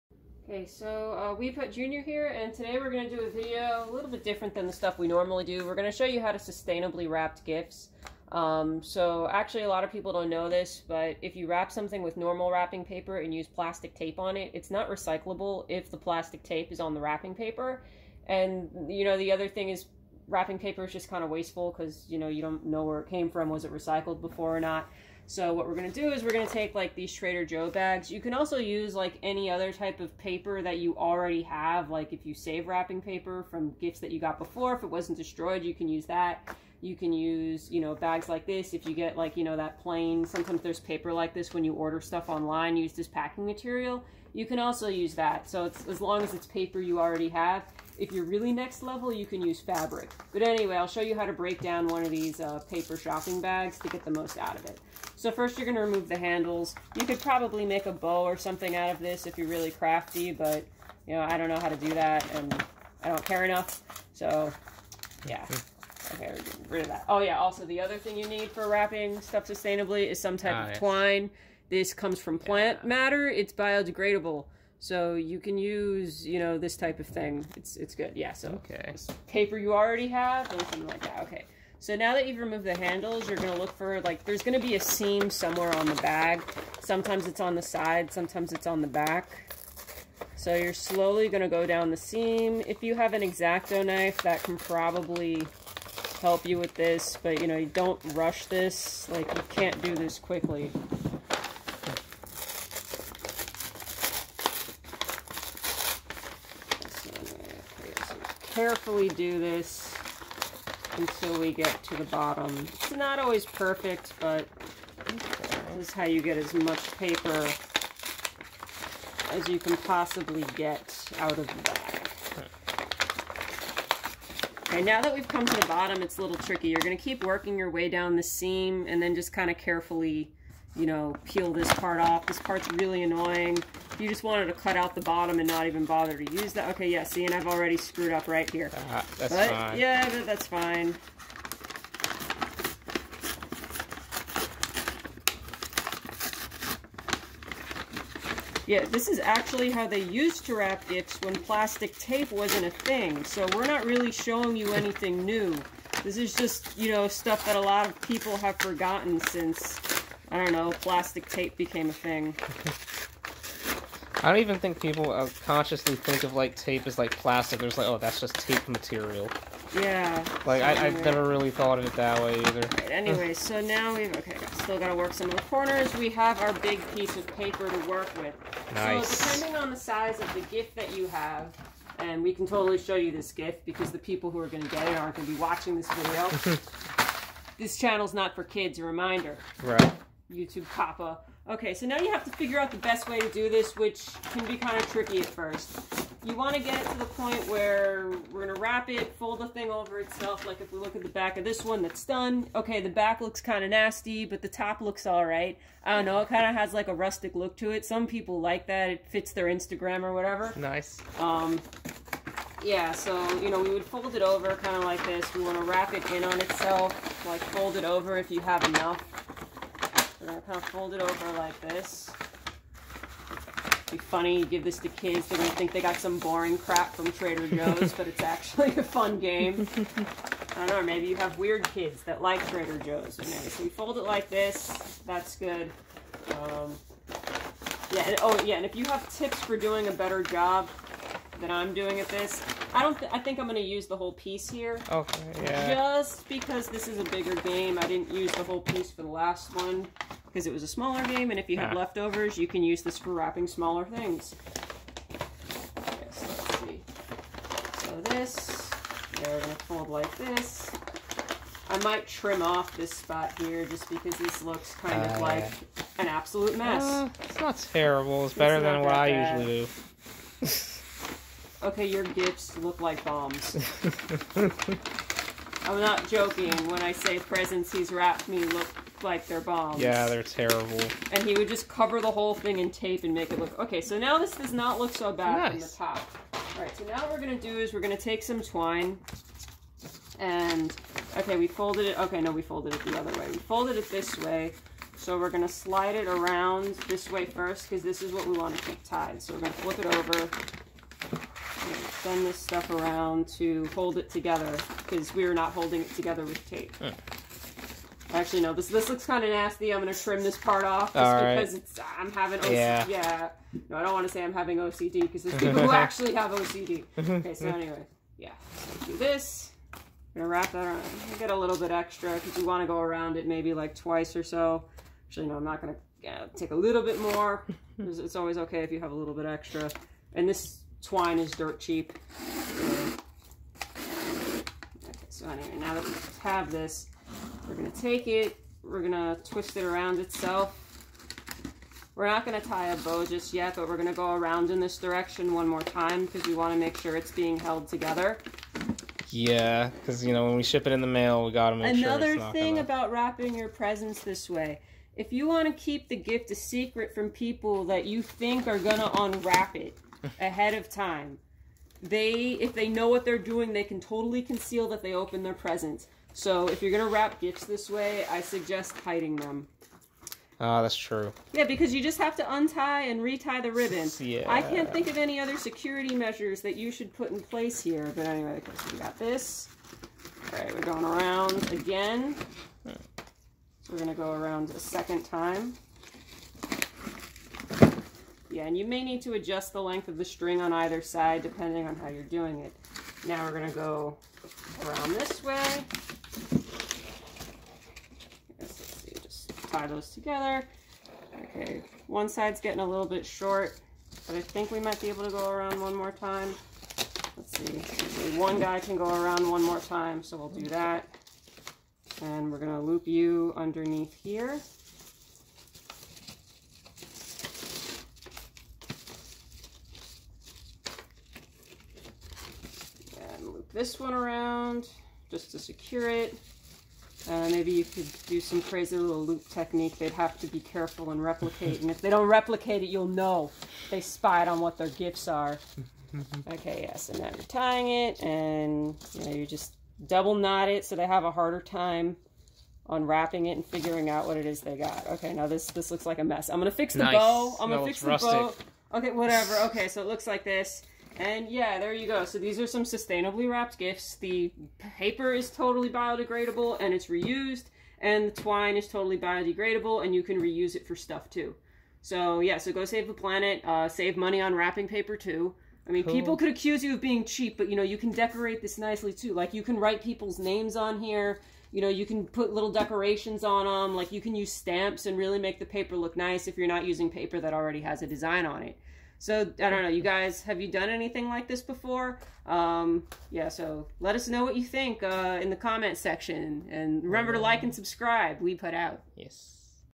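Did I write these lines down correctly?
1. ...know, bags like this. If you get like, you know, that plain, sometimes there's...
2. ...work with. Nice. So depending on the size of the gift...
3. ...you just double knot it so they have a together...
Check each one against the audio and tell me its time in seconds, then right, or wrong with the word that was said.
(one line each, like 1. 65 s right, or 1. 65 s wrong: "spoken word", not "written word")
1. 37 s right
2. 177 s right
3. 439 s wrong: "harder", not "together".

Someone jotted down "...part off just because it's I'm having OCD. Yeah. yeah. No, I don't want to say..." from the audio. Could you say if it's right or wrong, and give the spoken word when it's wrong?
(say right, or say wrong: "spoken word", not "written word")
right.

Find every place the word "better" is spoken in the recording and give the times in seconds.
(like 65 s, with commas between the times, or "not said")
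239 s, 268 s.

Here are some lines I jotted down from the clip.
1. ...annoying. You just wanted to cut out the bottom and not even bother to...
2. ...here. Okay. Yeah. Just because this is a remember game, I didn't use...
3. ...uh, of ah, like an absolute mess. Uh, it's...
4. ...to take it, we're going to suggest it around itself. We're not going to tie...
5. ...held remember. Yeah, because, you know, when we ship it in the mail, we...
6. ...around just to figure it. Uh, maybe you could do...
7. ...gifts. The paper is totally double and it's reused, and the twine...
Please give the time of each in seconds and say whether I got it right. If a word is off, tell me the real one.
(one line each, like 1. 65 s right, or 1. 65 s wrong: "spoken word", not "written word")
1. 133 s right
2. 244 s wrong: "bigger", not "remember"
3. 265 s right
4. 337 s wrong: "twist", not "suggest"
5. 347 s wrong: "together", not "remember"
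6. 423 s wrong: "secure", not "figure"
7. 453 s wrong: "biodegradable", not "double".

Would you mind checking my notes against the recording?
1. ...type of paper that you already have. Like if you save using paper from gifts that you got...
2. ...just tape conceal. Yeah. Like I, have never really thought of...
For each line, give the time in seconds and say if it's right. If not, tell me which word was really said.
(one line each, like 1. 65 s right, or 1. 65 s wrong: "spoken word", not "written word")
1. 29 s wrong: "wrapping", not "using"
2. 168 s wrong: "material", not "conceal".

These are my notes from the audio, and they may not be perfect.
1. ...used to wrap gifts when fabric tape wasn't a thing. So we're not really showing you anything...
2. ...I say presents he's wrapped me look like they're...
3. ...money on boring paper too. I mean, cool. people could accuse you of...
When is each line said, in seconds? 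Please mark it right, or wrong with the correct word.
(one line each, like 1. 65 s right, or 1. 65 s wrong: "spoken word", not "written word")
1. 150 s wrong: "plastic", not "fabric"
2. 276 s right
3. 463 s wrong: "wrapping", not "boring".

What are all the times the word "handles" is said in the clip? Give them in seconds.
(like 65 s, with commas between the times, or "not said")
56 s, 82 s.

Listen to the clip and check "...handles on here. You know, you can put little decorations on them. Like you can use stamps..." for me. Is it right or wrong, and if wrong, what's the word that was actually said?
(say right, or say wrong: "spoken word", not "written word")
wrong: "names", not "handles".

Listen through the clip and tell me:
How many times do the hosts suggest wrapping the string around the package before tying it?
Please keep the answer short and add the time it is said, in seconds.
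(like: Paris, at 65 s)
Twice, at 323 s.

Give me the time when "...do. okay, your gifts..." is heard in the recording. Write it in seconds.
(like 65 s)
270 s.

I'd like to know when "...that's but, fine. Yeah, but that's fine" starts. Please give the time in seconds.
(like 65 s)
139 s.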